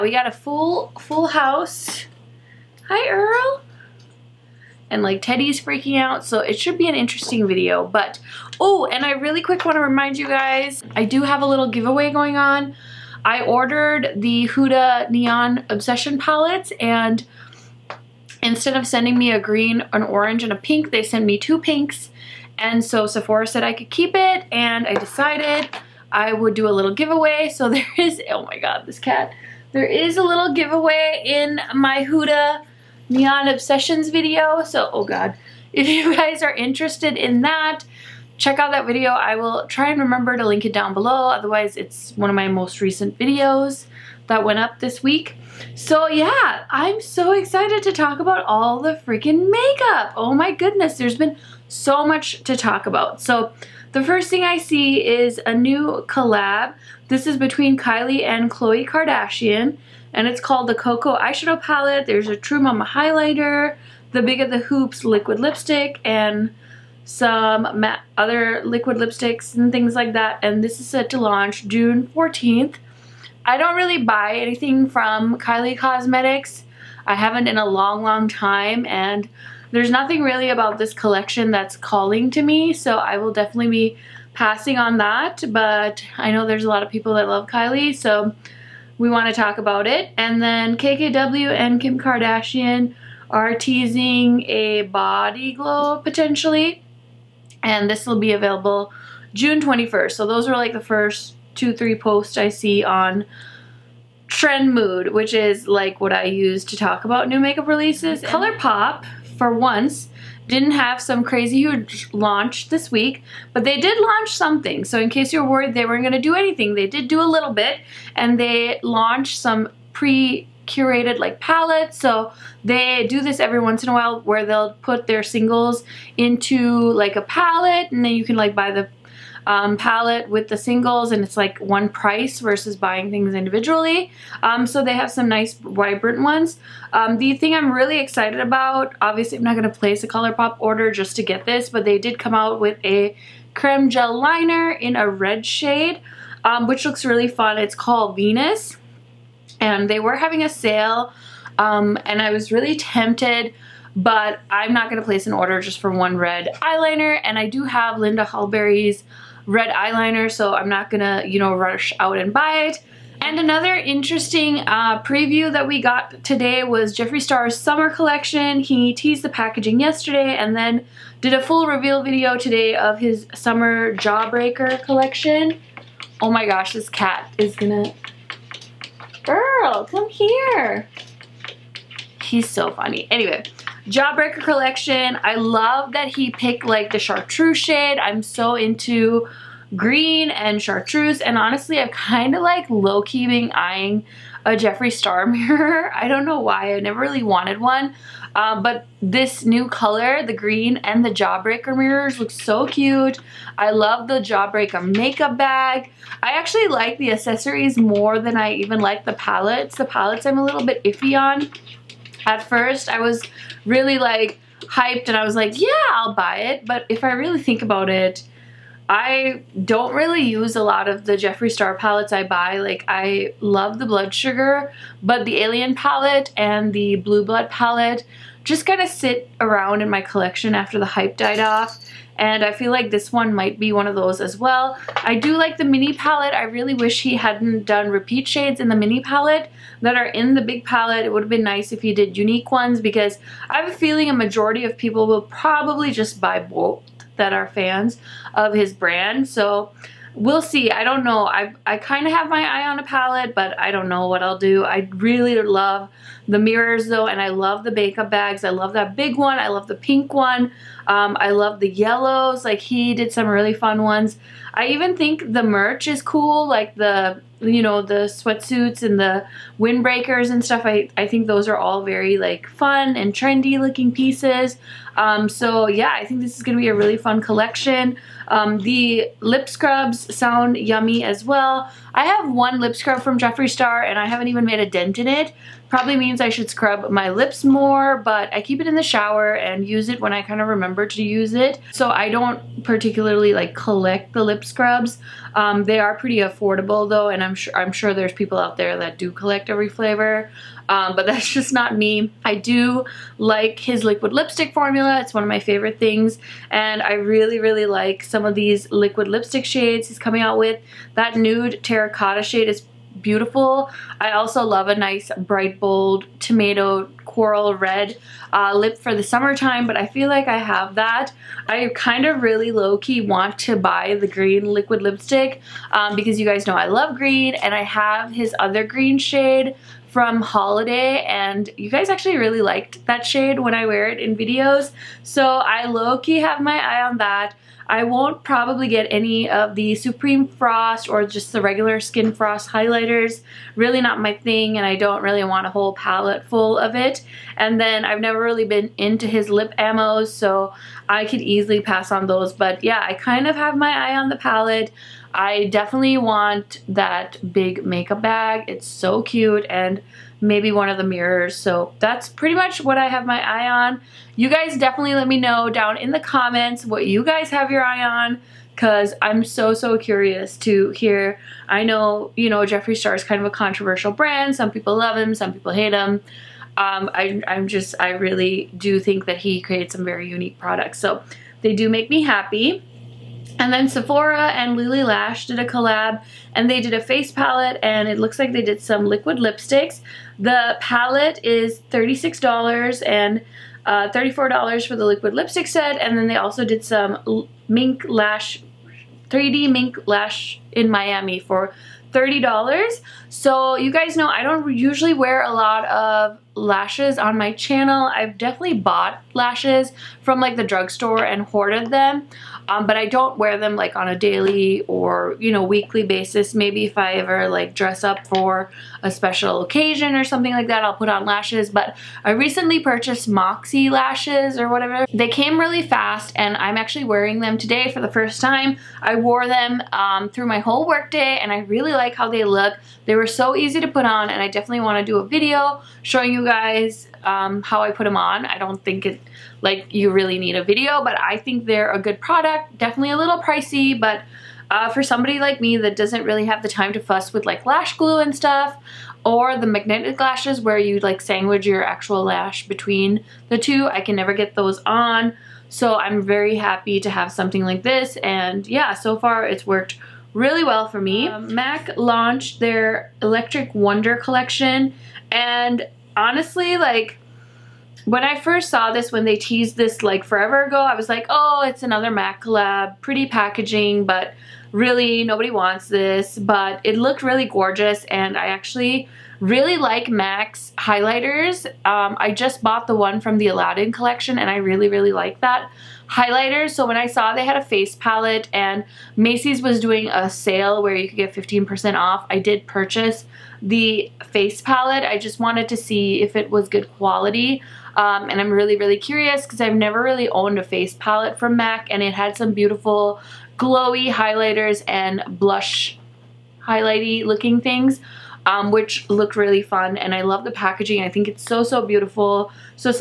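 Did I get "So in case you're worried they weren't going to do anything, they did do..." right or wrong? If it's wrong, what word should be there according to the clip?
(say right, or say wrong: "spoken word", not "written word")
right.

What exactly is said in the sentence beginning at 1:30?
And then KKW and Kim Kardashian are teasing a body glow potentially, and this will be available June 21st.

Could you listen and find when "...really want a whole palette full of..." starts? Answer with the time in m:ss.
5:45.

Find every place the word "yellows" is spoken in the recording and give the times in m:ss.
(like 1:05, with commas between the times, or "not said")
4:21.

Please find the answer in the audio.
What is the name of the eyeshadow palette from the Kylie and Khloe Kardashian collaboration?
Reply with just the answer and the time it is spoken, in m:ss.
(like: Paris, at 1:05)
Cocoa, at 1:00.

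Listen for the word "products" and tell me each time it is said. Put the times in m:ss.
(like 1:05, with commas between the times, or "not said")
6:20, 7:22.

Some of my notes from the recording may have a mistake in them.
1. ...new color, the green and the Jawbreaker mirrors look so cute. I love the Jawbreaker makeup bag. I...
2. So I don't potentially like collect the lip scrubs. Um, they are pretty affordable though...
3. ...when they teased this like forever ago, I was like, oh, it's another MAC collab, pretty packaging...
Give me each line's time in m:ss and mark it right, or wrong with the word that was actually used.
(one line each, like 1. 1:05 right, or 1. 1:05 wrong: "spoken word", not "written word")
1. 3:19 right
2. 4:51 wrong: "particularly", not "potentially"
3. 7:48 right.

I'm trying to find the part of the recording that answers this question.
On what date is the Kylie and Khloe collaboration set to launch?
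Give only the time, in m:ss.
1:11.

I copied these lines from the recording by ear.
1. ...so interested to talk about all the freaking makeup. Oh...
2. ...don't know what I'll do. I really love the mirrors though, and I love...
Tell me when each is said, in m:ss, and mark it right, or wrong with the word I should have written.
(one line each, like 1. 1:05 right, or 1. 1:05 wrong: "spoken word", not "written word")
1. 0:47 wrong: "excited", not "interested"
2. 4:13 right.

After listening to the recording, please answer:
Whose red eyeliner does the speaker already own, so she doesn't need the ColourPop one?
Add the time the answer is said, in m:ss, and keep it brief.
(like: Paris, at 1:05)
Linda Hallberg, at 2:37.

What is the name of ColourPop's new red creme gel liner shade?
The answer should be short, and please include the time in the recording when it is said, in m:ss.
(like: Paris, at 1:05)
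Venus, at 2:28.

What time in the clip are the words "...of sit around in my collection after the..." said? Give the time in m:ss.
3:48.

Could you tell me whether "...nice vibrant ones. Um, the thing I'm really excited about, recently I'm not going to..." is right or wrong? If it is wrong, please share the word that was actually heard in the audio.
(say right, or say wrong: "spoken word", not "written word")
wrong: "obviously", not "recently".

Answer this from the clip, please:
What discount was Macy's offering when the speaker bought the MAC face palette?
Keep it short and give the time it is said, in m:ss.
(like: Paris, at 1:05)
15%, at 8:11.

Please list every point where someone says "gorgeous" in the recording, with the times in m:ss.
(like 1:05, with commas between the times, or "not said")
7:57.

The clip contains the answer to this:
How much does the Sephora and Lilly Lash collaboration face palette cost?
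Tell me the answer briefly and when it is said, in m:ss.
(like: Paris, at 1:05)
$36, at 6:31.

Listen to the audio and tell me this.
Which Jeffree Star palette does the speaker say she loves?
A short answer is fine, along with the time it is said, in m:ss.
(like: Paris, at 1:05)
Blood Sugar, at 3:43.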